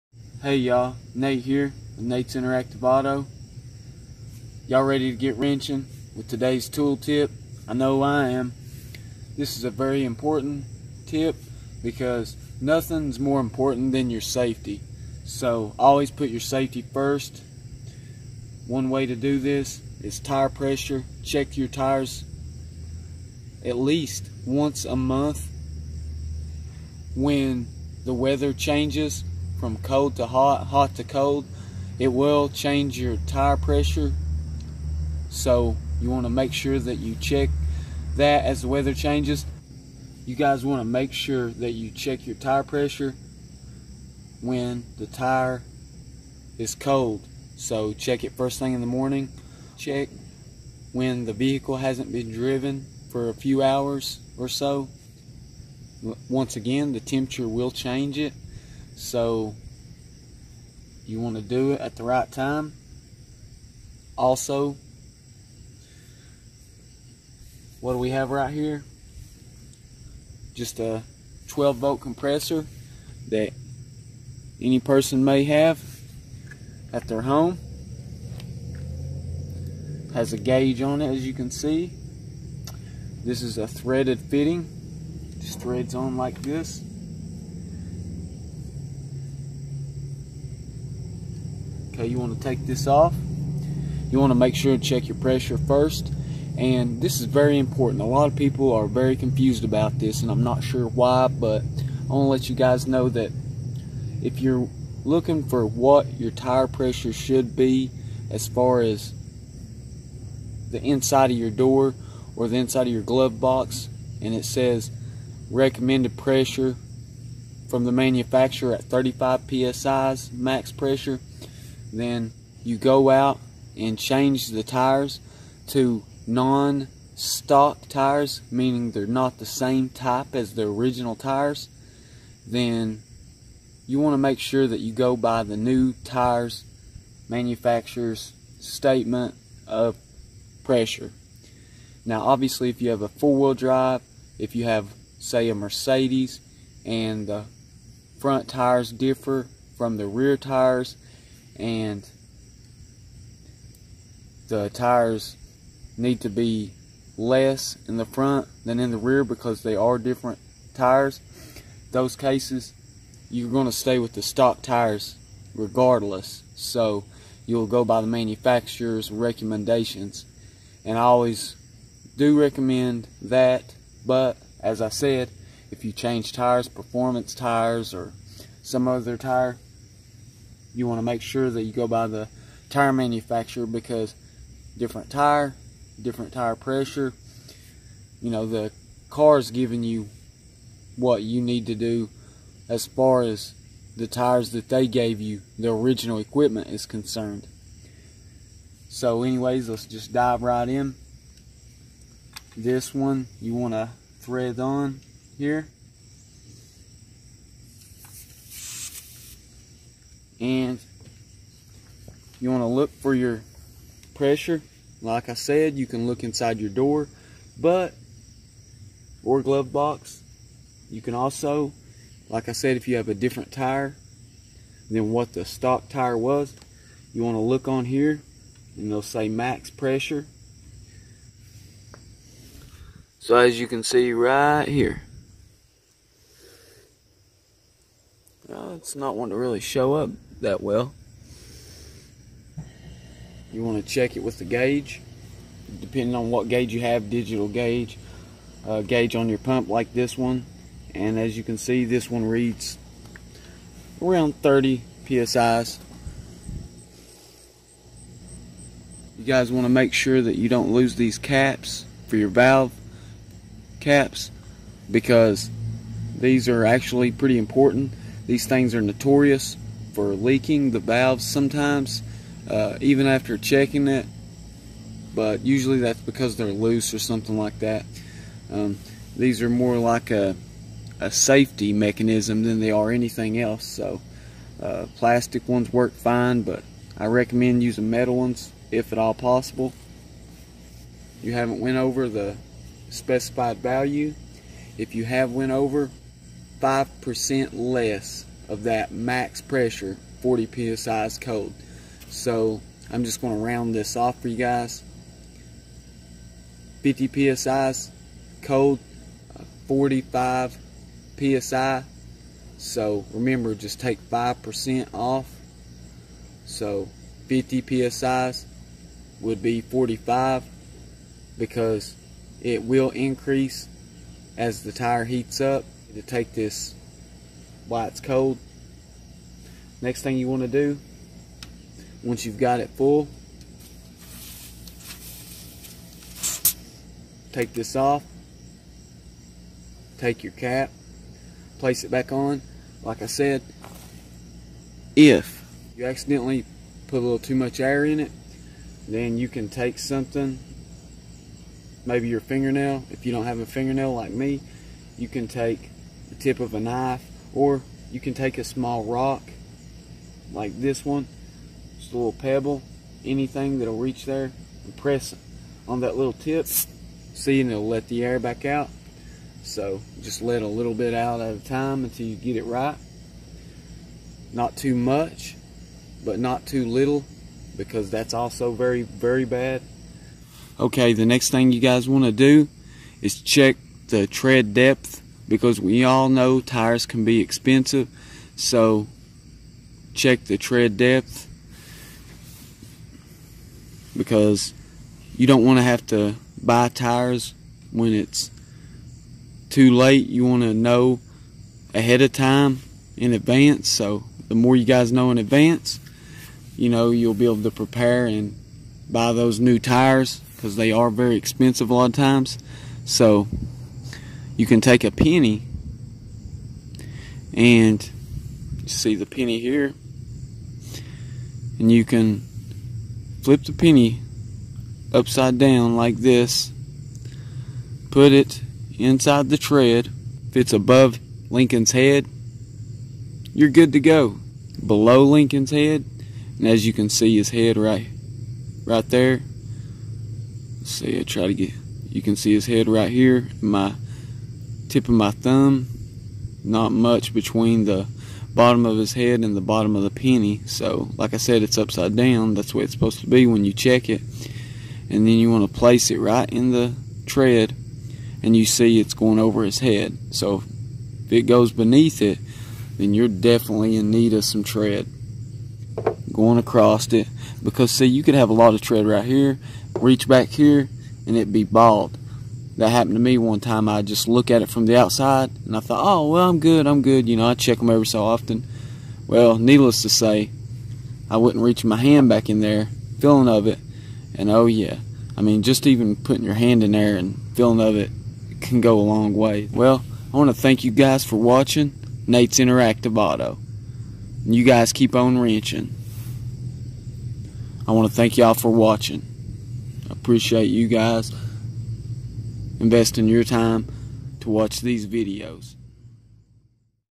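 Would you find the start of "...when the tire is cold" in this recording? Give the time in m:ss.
0:44.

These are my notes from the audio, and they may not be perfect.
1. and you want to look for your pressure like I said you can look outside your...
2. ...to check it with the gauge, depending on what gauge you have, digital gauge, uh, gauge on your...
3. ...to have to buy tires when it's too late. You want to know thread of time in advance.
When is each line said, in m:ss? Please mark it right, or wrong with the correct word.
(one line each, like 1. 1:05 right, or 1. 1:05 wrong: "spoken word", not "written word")
1. 3:30 wrong: "inside", not "outside"
2. 4:03 right
3. 6:35 wrong: "ahead", not "thread".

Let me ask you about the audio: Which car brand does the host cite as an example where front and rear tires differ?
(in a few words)
Mercedes.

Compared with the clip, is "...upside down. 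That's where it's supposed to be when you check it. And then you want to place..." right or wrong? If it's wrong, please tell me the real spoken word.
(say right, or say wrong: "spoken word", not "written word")
right.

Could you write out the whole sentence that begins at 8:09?
Well, I want to thank you guys for watching Nate's Interactive Auto.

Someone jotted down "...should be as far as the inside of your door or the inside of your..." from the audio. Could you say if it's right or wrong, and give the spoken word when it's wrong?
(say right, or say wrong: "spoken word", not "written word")
right.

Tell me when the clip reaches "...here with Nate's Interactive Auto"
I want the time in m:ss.
0:01.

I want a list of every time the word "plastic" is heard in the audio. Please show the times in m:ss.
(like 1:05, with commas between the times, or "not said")
4:44.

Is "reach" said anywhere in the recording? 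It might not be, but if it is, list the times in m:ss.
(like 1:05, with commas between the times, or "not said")
6:03, 7:49, 8:01.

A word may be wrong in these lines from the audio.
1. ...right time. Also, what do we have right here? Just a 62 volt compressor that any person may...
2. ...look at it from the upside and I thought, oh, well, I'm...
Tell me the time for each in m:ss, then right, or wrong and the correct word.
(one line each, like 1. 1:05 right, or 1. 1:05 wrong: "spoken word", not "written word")
1. 1:02 wrong: "12", not "62"
2. 7:54 wrong: "outside", not "upside".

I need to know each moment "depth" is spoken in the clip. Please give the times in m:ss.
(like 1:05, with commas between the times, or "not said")
6:24, 6:30.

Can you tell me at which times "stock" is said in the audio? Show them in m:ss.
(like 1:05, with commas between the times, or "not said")
2:07, 2:44, 3:45.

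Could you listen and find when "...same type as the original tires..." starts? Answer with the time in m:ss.
2:09.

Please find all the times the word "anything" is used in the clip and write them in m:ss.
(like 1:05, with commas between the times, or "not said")
4:42, 6:03.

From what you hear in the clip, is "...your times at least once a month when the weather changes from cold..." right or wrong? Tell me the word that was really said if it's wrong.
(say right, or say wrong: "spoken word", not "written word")
wrong: "tires", not "times".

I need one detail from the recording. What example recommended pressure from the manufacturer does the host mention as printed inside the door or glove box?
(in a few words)
35 psi.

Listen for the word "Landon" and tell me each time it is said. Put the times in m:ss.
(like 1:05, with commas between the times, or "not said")
not said.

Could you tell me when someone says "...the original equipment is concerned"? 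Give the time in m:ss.
3:15.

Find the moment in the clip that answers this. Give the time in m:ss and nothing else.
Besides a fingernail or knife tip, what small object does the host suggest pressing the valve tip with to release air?
5:58.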